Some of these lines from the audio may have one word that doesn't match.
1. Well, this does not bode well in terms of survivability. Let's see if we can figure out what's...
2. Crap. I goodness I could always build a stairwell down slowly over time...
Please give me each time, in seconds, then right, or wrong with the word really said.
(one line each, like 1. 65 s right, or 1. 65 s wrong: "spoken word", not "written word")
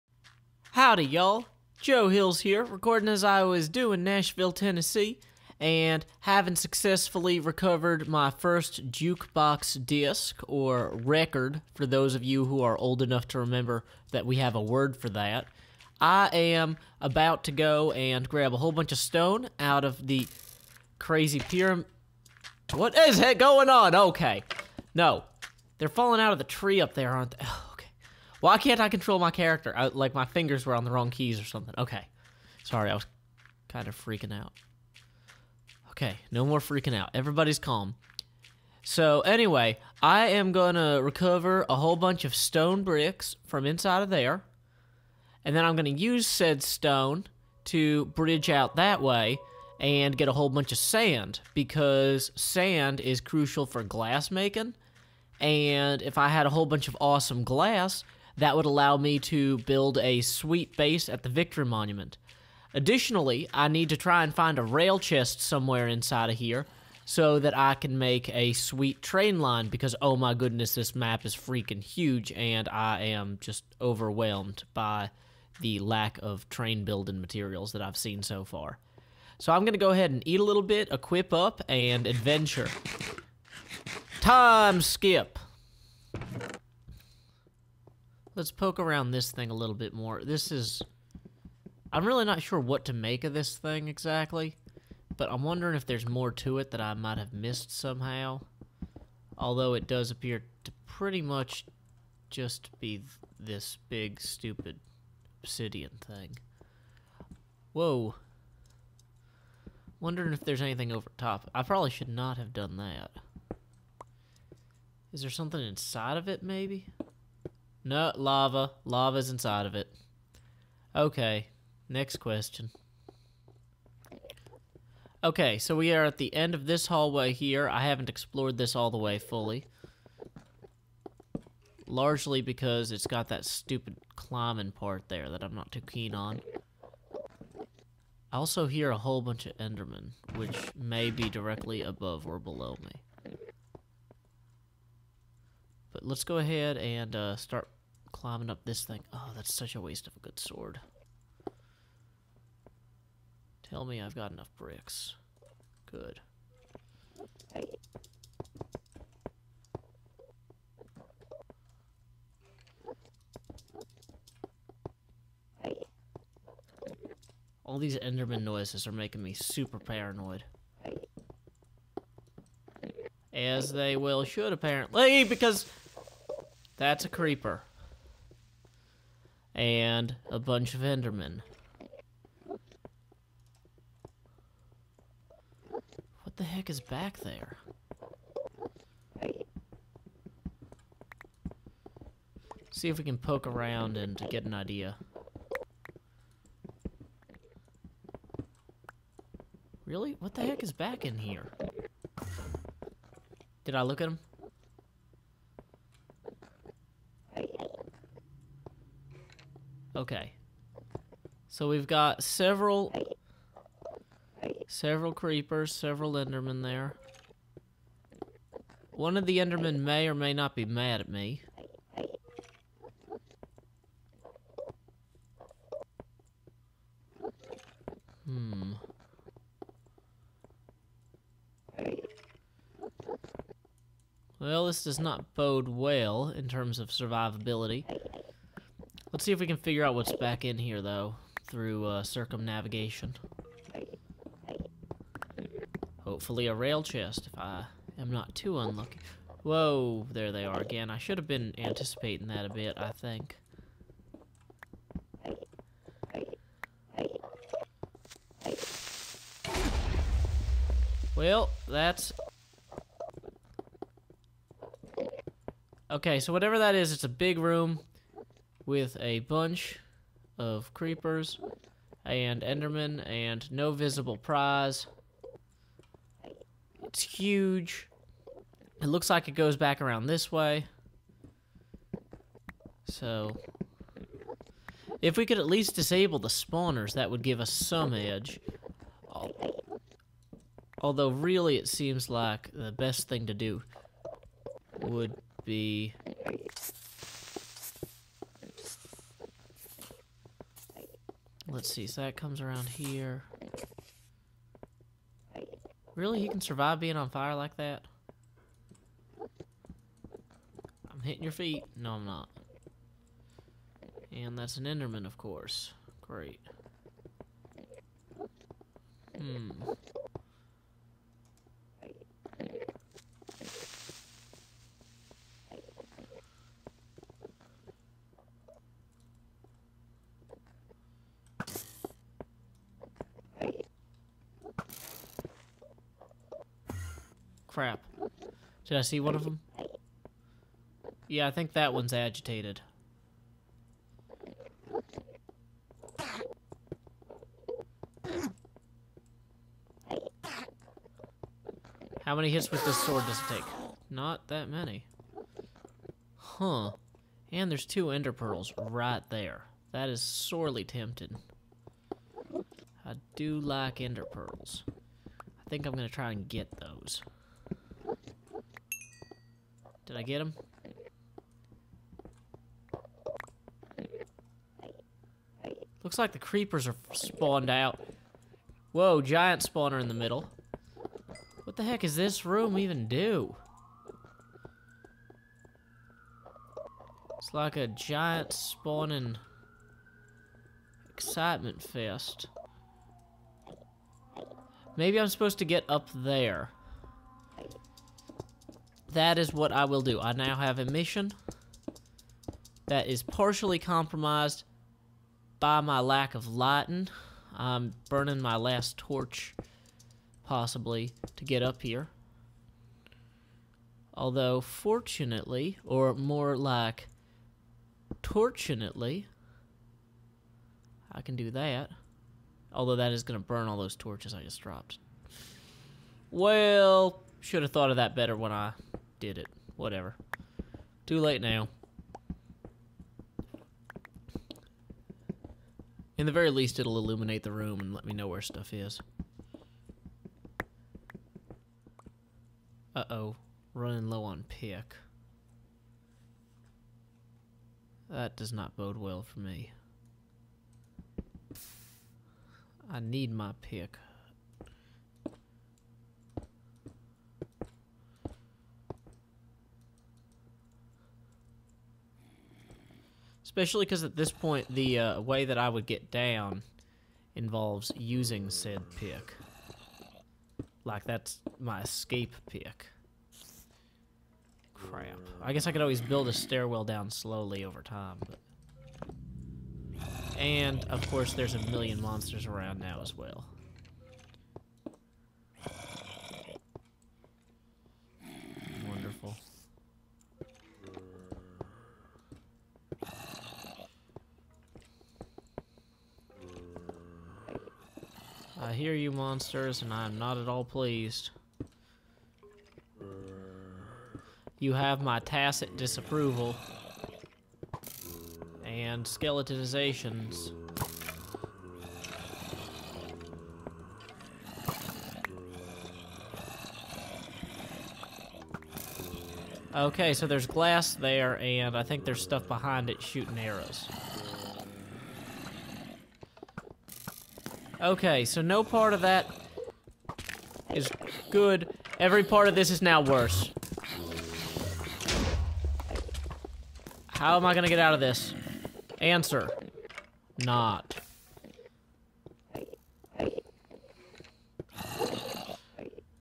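1. 234 s right
2. 474 s wrong: "guess", not "goodness".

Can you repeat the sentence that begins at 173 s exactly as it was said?
As they will should, apparently, because that's a creeper.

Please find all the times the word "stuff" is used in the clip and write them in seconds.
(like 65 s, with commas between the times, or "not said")
438 s, 522 s.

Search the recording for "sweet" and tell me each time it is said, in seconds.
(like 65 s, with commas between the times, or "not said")
60 s, 68 s.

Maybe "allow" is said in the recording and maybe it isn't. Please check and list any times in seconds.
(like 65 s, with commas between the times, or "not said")
58 s.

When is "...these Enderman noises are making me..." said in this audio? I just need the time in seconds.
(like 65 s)
167 s.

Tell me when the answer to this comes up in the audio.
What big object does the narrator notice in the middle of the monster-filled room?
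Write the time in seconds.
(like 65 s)
379 s.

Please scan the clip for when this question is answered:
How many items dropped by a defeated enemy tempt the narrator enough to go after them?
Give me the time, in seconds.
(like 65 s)
357 s.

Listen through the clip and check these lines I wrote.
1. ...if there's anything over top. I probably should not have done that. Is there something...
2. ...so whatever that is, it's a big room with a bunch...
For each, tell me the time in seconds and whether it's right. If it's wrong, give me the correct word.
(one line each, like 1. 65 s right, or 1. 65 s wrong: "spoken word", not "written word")
1. 110 s right
2. 266 s right.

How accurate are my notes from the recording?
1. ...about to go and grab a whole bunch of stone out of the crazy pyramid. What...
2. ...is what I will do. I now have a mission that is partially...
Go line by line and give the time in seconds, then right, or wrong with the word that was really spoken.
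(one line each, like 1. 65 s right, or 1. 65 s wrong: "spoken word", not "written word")
1. 17 s right
2. 399 s right.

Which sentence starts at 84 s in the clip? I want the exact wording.
Time skip let's poke around this thing a little bit more.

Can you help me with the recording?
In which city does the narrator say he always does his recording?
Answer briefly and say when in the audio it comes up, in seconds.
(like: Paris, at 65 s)
Nashville, Tennessee, at 4 s.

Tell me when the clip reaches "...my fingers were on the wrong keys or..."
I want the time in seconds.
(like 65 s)
30 s.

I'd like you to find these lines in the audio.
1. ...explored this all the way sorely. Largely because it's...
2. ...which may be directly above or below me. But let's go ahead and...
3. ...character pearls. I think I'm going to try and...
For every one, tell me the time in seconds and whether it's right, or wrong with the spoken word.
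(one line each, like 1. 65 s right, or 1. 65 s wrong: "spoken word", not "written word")
1. 128 s wrong: "fully", not "sorely"
2. 140 s right
3. 363 s wrong: "ender", not "character".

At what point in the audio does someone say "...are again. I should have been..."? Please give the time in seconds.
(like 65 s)
250 s.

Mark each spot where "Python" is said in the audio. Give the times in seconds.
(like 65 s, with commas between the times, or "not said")
not said.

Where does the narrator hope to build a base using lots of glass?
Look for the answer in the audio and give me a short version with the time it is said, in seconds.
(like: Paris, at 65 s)
Victory Monument, at 61 s.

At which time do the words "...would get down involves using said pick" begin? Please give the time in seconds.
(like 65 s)
465 s.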